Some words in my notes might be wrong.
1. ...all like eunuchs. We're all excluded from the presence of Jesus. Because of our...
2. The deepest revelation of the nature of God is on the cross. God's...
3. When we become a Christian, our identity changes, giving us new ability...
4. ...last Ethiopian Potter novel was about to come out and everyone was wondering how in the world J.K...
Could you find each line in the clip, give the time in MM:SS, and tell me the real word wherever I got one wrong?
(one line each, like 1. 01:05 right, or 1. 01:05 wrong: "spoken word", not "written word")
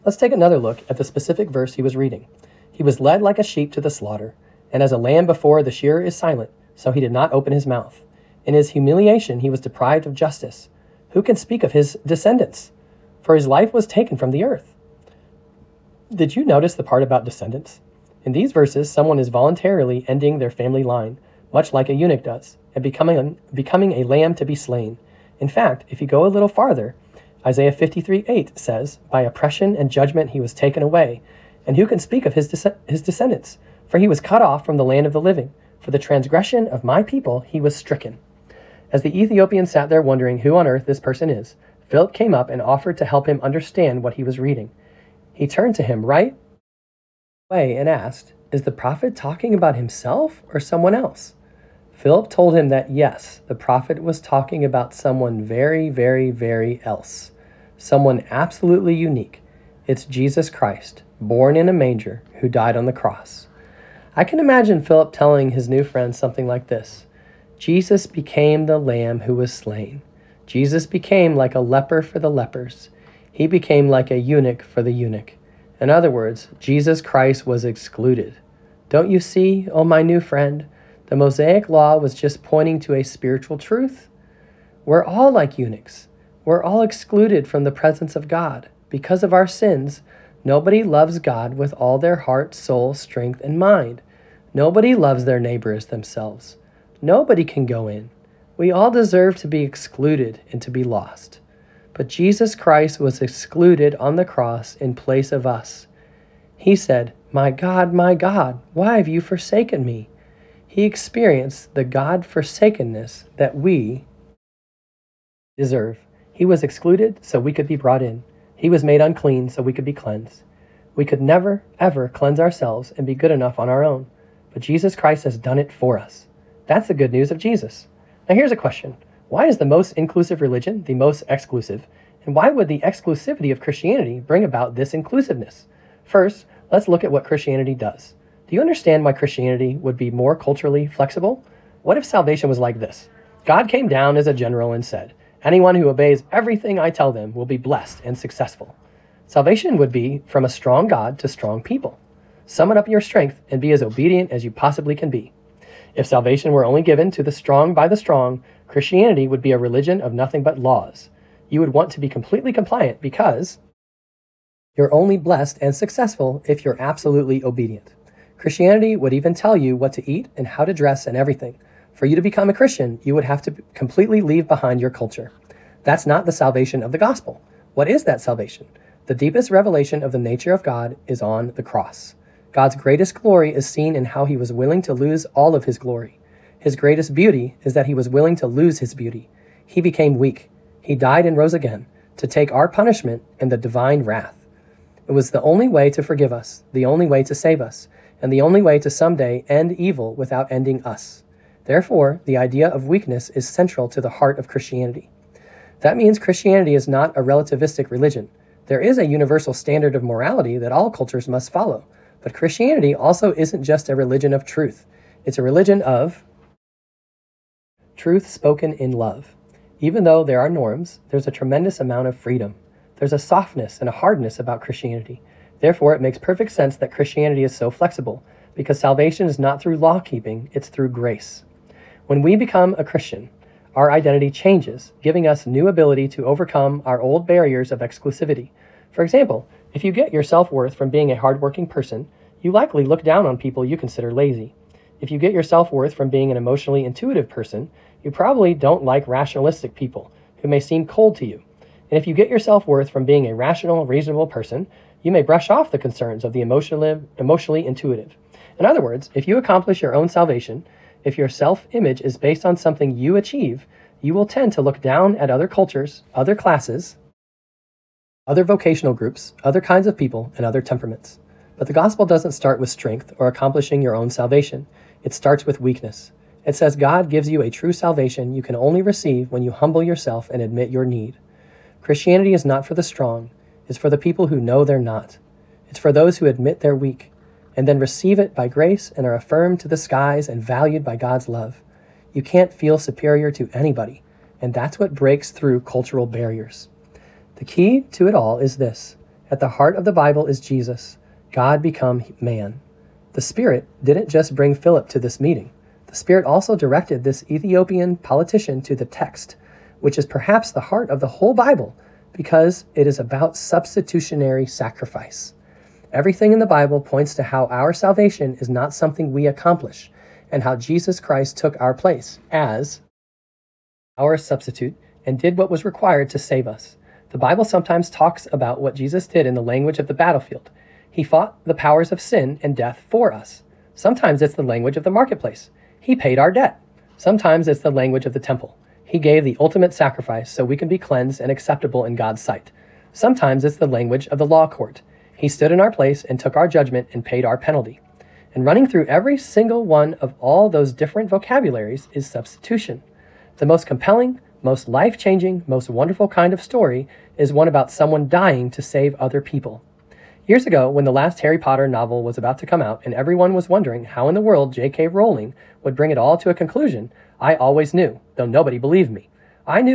1. 01:25 wrong: "God", not "Jesus"
2. 02:59 right
3. 03:52 right
4. 06:00 wrong: "Harry", not "Ethiopian".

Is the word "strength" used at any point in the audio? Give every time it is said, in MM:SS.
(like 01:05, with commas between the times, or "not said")
01:32, 02:32, 04:32.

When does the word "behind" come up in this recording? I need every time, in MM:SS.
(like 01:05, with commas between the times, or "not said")
02:54.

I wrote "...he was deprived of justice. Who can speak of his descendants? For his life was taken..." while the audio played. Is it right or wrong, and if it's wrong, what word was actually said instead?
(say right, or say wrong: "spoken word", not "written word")
right.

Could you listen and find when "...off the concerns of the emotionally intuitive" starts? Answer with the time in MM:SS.
04:15.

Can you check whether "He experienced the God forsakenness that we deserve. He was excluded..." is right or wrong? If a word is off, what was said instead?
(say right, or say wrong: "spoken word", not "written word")
right.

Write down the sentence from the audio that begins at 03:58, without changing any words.
For example, if you get your self worth from being a hardworking person, you likely look down on people you consider lazy.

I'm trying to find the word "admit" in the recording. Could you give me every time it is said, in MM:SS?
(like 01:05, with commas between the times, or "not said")
04:40, 04:46.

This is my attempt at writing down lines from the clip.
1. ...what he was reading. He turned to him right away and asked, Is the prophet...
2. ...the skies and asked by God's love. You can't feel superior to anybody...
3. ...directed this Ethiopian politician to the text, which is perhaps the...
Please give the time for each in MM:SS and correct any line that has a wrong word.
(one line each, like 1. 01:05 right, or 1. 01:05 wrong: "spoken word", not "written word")
1. 00:44 right
2. 04:49 wrong: "valued", not "asked"
3. 05:06 right.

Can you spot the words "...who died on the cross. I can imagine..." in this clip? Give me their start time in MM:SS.
01:02.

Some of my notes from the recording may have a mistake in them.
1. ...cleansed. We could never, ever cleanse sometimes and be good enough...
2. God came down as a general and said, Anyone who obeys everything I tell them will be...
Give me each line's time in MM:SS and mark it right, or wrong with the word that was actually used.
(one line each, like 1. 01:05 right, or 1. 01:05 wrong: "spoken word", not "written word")
1. 01:59 wrong: "ourselves", not "sometimes"
2. 02:23 right.